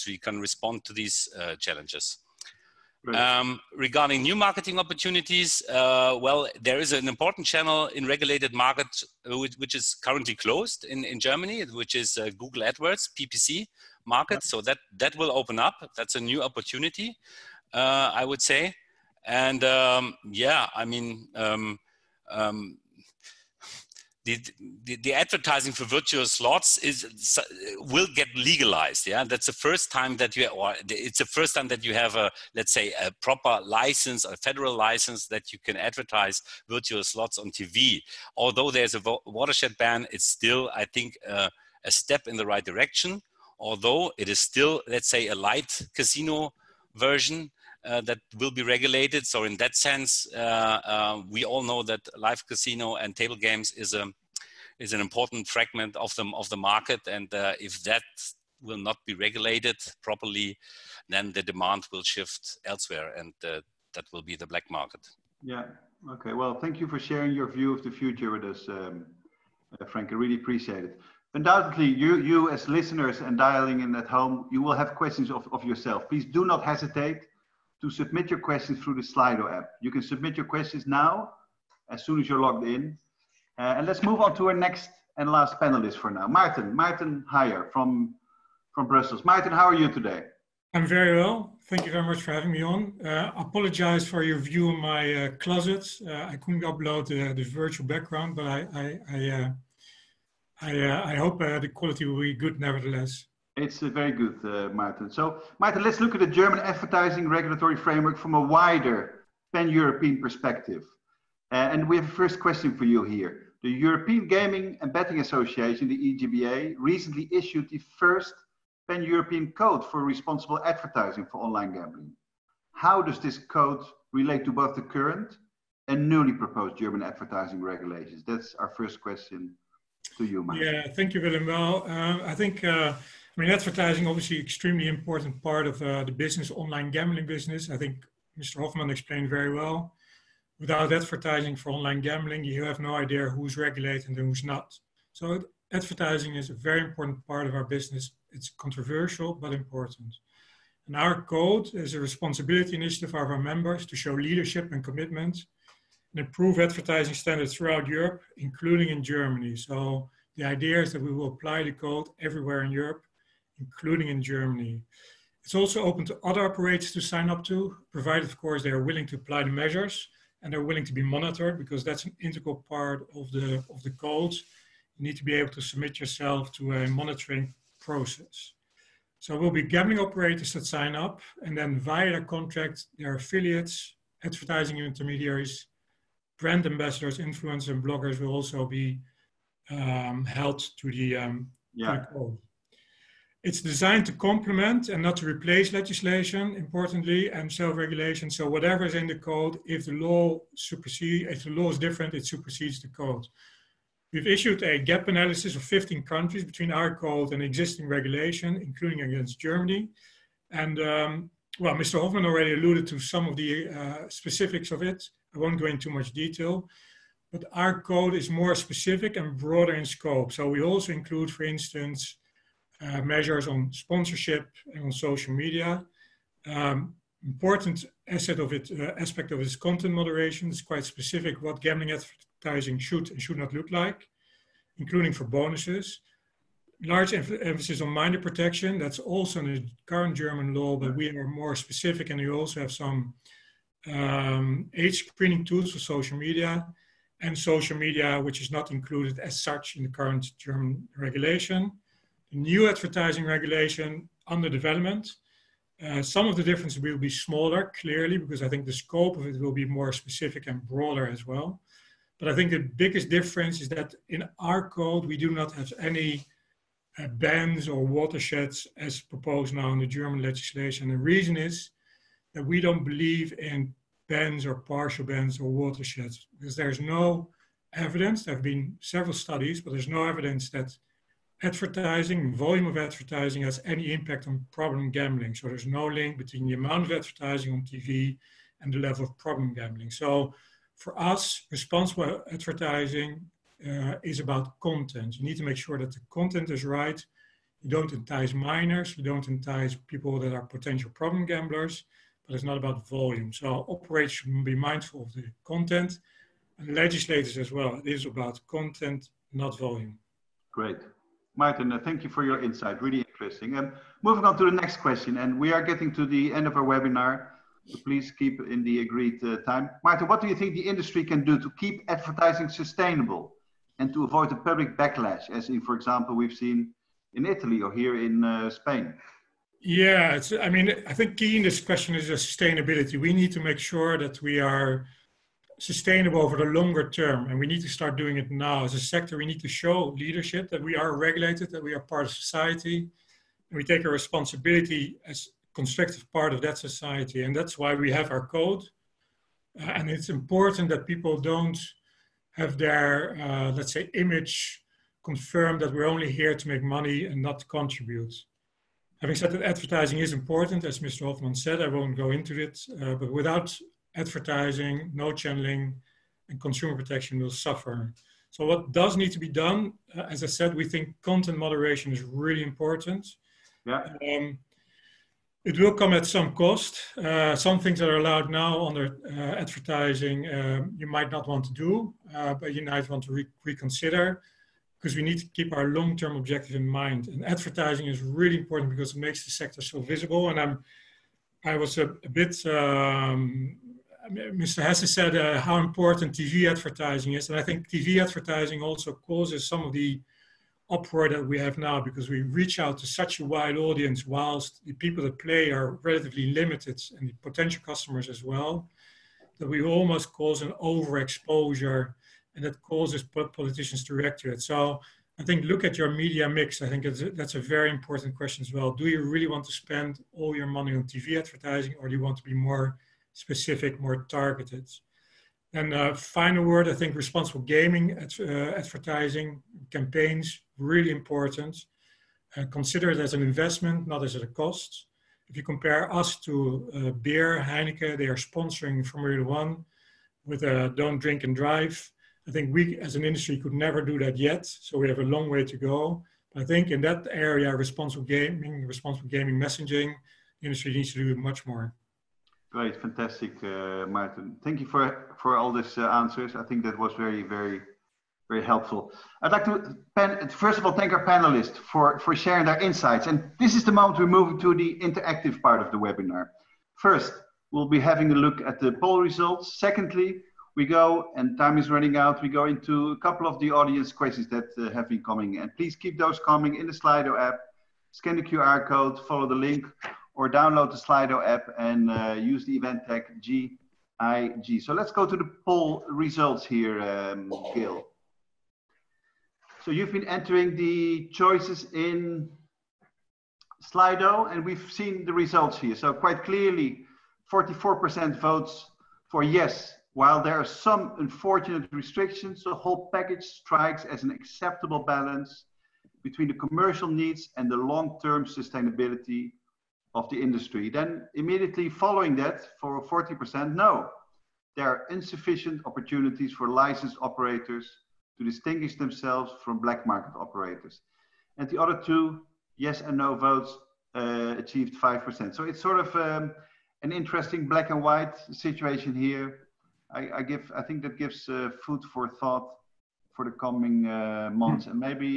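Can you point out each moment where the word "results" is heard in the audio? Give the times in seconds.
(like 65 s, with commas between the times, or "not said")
468 s, 485 s, 495 s.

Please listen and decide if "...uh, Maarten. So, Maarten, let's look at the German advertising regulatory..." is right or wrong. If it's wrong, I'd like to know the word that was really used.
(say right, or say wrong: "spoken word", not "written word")
right.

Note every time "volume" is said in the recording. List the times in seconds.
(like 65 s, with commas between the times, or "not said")
282 s, 302 s, 309 s.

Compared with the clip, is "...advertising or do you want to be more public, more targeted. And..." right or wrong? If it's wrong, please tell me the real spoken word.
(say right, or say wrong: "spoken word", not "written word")
wrong: "specific", not "public".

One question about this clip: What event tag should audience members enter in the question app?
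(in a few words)
GIG.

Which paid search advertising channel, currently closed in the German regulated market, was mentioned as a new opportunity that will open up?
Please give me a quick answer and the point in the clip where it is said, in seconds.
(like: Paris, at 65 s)
Google AdWords, at 12 s.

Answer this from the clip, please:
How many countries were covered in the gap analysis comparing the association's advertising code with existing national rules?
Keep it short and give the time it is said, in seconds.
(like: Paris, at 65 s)
15, at 205 s.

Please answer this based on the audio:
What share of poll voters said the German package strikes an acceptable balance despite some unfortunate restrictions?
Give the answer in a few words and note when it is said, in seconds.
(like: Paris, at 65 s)
44%, at 497 s.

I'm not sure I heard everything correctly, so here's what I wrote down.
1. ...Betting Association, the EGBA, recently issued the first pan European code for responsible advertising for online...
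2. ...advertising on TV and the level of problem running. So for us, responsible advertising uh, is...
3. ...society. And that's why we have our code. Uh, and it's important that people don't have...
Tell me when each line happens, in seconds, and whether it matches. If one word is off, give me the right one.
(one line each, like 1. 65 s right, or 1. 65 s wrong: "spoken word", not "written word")
1. 114 s right
2. 286 s wrong: "gambling", not "running"
3. 346 s right.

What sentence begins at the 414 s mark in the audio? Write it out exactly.
So I think look at your media mix.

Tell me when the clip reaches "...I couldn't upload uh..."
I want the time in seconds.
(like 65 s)
96 s.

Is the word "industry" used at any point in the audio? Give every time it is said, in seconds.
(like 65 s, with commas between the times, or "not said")
320 s, 443 s, 450 s, 510 s.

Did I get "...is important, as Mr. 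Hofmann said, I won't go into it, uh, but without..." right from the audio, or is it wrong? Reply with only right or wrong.
right.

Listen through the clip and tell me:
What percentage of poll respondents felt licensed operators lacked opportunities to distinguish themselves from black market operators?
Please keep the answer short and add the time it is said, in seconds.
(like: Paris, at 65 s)
40%, at 512 s.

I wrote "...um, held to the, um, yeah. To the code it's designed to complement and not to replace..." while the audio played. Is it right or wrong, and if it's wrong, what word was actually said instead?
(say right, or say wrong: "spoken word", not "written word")
right.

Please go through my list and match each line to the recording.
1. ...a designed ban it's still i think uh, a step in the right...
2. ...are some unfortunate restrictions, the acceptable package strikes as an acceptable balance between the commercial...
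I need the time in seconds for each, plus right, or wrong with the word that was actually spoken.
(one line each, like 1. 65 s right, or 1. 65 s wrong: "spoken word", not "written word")
1. 38 s wrong: "watershed", not "designed"
2. 500 s wrong: "whole", not "acceptable".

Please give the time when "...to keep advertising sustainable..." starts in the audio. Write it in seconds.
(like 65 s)
321 s.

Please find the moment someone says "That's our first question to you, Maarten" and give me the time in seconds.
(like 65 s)
128 s.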